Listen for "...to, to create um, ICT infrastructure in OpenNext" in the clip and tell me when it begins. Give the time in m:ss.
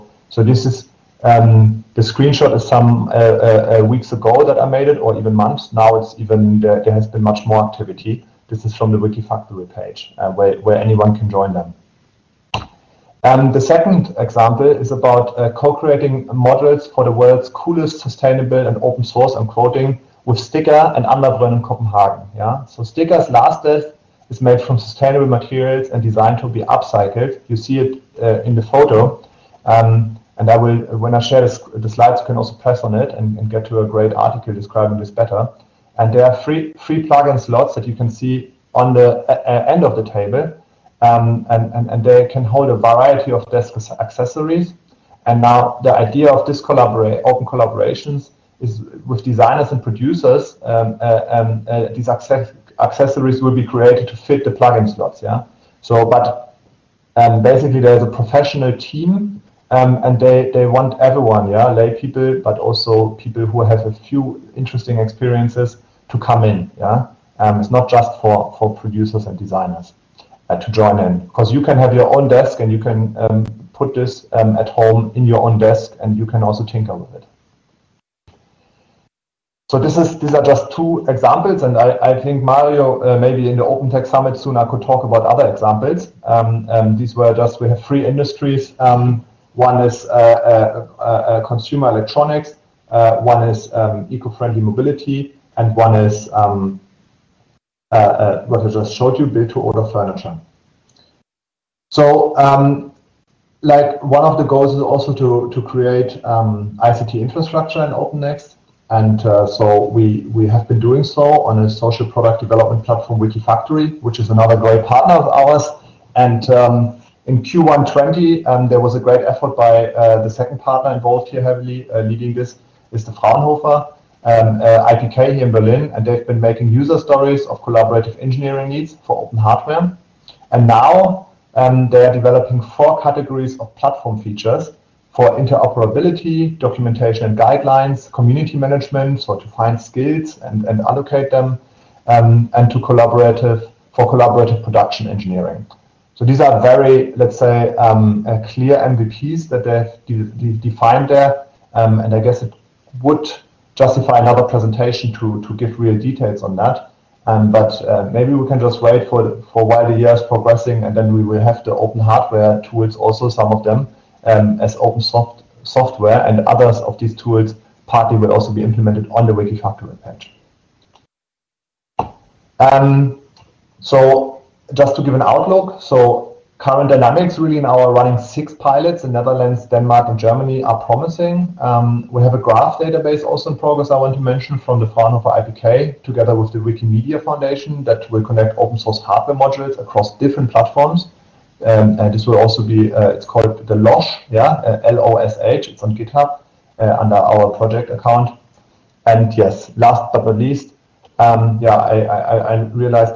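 1:45.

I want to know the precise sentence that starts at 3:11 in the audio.
Um, and this will also be, uh, it's called the LOSH, yeah, uh, L-O-S-H, it's on GitHub uh, under our project account.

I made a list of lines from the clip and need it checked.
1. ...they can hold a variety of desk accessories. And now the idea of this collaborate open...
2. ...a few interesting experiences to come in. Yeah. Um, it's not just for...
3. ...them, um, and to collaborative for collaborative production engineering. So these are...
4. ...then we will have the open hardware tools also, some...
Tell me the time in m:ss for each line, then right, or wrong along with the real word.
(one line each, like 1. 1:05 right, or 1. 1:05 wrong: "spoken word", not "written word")
1. 0:42 right
2. 1:03 right
3. 2:21 right
4. 2:40 right.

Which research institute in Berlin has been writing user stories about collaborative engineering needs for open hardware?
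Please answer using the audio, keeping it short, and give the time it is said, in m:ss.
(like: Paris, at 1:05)
Fraunhofer IPK, at 2:03.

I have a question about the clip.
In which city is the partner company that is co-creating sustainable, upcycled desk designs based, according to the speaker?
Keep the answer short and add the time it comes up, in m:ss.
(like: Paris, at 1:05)
Copenhagen, at 0:21.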